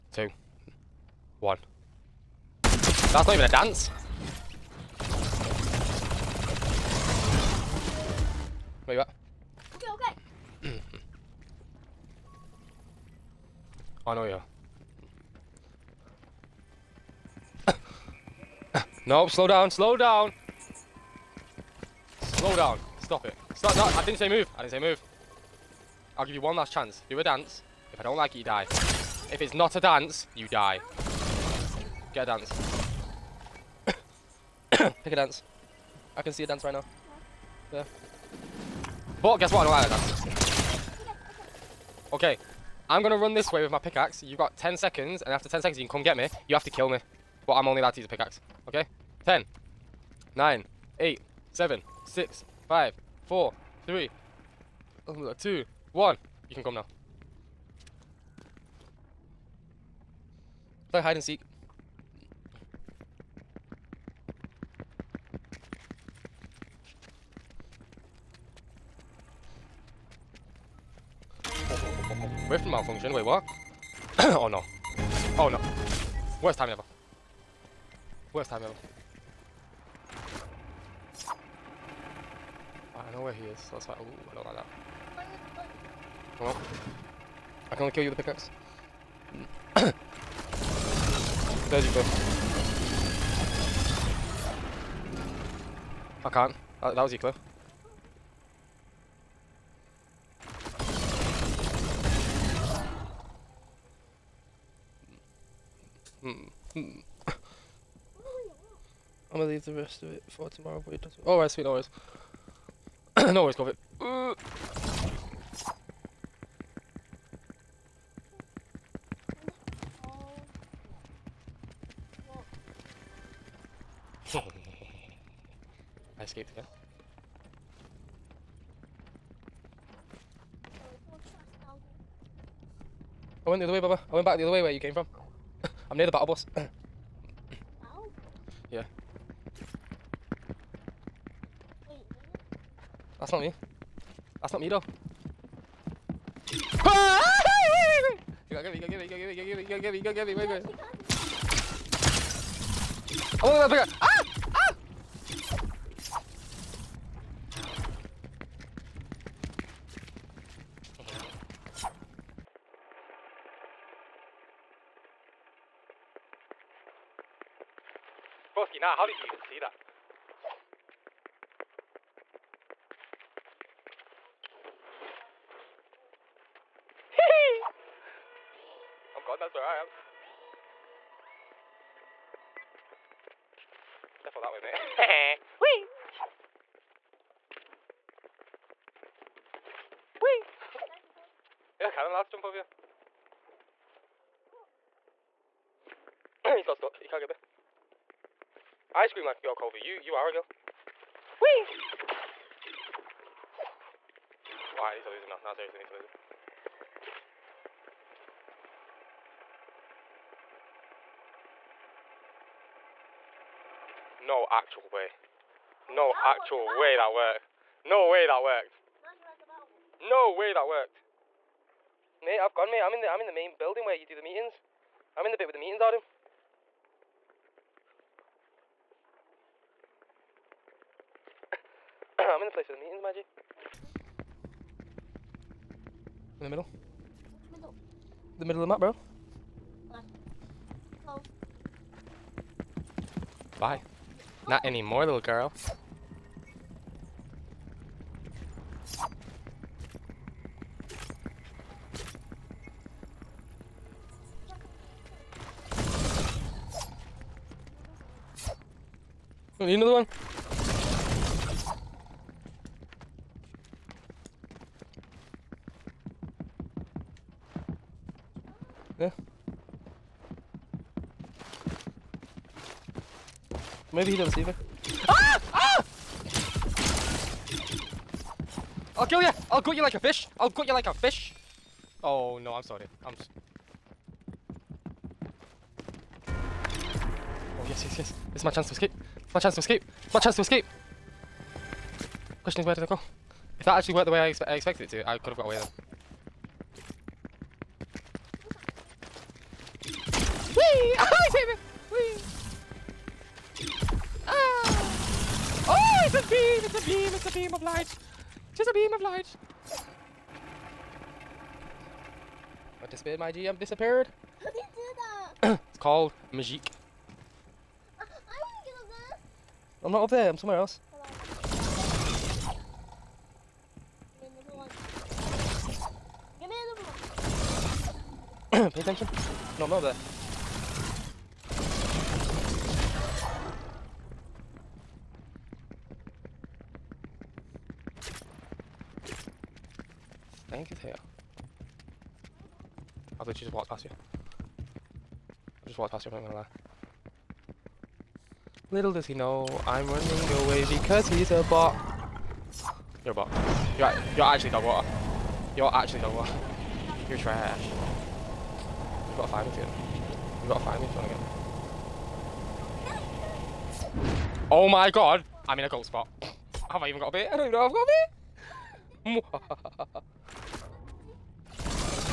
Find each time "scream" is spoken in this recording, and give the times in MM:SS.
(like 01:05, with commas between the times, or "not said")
03:19.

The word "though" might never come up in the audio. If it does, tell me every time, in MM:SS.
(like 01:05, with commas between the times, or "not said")
02:24.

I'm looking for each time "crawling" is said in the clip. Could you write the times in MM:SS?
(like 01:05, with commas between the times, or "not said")
not said.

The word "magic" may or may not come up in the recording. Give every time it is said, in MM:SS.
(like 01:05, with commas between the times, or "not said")
05:16.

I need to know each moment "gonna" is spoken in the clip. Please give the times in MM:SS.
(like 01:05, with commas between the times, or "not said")
01:49, 05:46.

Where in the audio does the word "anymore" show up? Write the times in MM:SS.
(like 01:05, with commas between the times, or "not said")
04:04.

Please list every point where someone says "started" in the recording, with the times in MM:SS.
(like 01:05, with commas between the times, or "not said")
not said.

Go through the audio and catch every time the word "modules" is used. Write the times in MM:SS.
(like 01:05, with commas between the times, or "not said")
not said.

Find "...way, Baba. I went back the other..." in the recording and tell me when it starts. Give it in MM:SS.
02:13.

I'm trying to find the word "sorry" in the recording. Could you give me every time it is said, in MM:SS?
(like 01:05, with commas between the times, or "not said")
04:42.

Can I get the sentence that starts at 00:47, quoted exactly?
But I'm only allowed to use a pickaxe.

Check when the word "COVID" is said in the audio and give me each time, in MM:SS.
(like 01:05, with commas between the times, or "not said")
01:53.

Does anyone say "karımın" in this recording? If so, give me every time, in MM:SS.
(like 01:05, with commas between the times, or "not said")
03:11.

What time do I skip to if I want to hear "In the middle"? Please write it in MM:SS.
03:56.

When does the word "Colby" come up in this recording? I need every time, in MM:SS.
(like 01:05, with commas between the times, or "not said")
03:19.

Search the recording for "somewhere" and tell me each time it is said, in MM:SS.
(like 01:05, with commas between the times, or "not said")
05:20.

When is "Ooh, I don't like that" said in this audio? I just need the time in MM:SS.
01:23.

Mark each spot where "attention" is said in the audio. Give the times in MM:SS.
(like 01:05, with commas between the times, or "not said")
05:28.